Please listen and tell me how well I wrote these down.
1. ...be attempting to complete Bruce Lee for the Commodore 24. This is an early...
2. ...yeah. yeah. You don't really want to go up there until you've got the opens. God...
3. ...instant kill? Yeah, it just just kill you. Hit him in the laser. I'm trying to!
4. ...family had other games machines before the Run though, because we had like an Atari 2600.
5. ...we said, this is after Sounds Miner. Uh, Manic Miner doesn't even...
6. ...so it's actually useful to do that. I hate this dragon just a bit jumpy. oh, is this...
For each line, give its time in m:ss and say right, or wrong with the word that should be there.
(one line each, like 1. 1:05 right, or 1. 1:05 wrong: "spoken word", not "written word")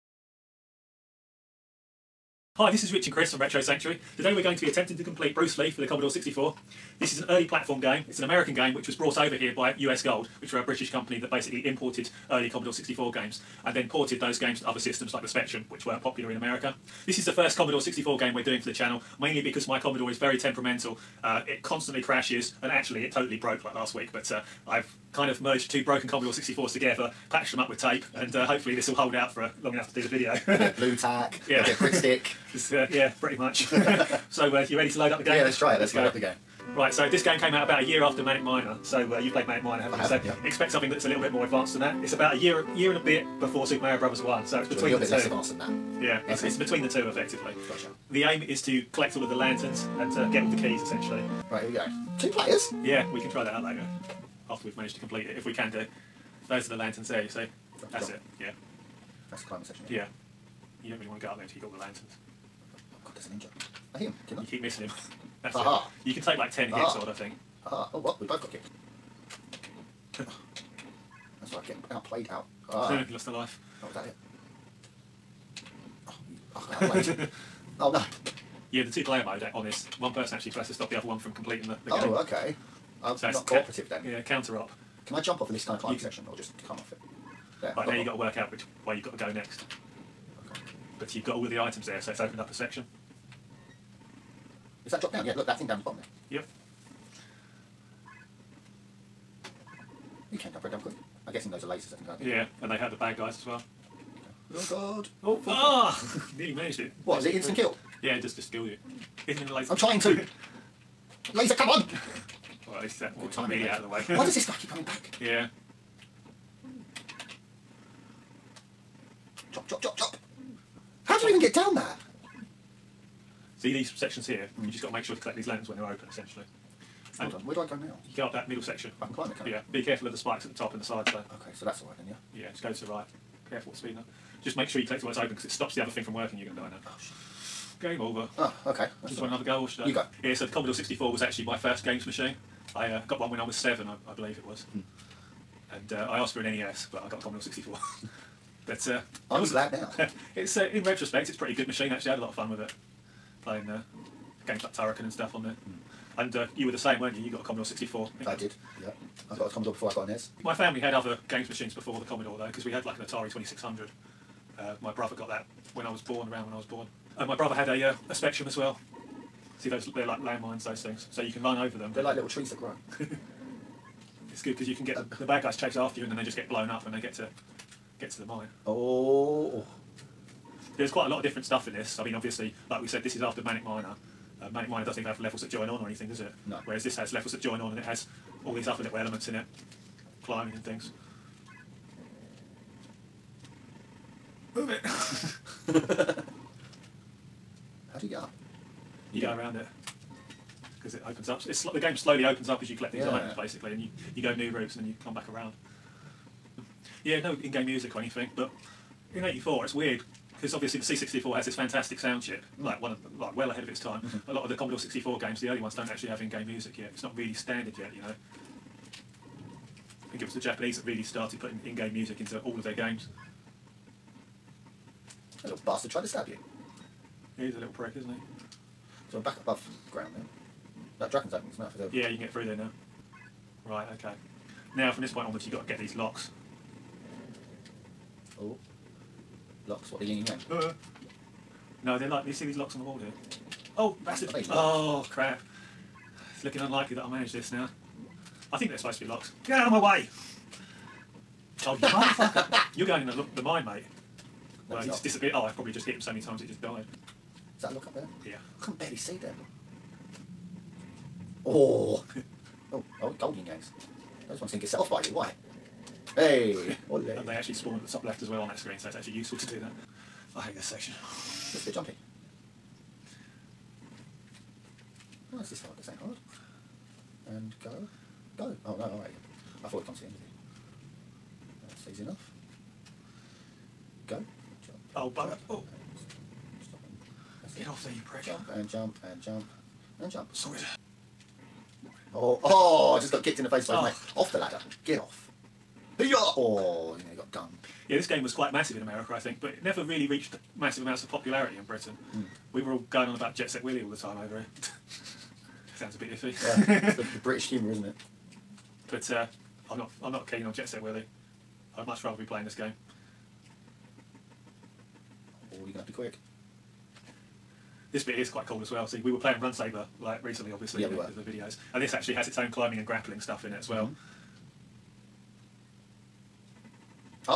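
1. 0:04 wrong: "64", not "24"
2. 0:59 wrong: "lanterns", not "opens"
3. 1:47 right
4. 2:40 wrong: "Commodore", not "Run"
5. 3:02 wrong: "Manic", not "Sounds"
6. 4:28 wrong: "section", not "dragon".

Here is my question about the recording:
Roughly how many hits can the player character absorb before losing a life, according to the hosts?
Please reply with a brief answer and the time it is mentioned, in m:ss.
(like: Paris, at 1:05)
10, at 1:06.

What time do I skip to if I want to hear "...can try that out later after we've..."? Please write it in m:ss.
0:53.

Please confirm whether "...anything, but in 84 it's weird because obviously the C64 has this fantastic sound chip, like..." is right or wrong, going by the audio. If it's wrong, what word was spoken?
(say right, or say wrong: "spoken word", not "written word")
right.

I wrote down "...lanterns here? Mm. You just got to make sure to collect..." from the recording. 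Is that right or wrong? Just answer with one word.
wrong.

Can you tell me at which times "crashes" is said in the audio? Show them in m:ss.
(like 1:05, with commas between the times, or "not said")
0:22.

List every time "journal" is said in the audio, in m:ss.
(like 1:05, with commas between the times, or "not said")
not said.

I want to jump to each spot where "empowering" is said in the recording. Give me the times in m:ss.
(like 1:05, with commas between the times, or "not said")
not said.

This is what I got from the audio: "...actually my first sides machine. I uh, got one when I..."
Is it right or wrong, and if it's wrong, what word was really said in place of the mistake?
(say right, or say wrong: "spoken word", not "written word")
wrong: "games", not "sides".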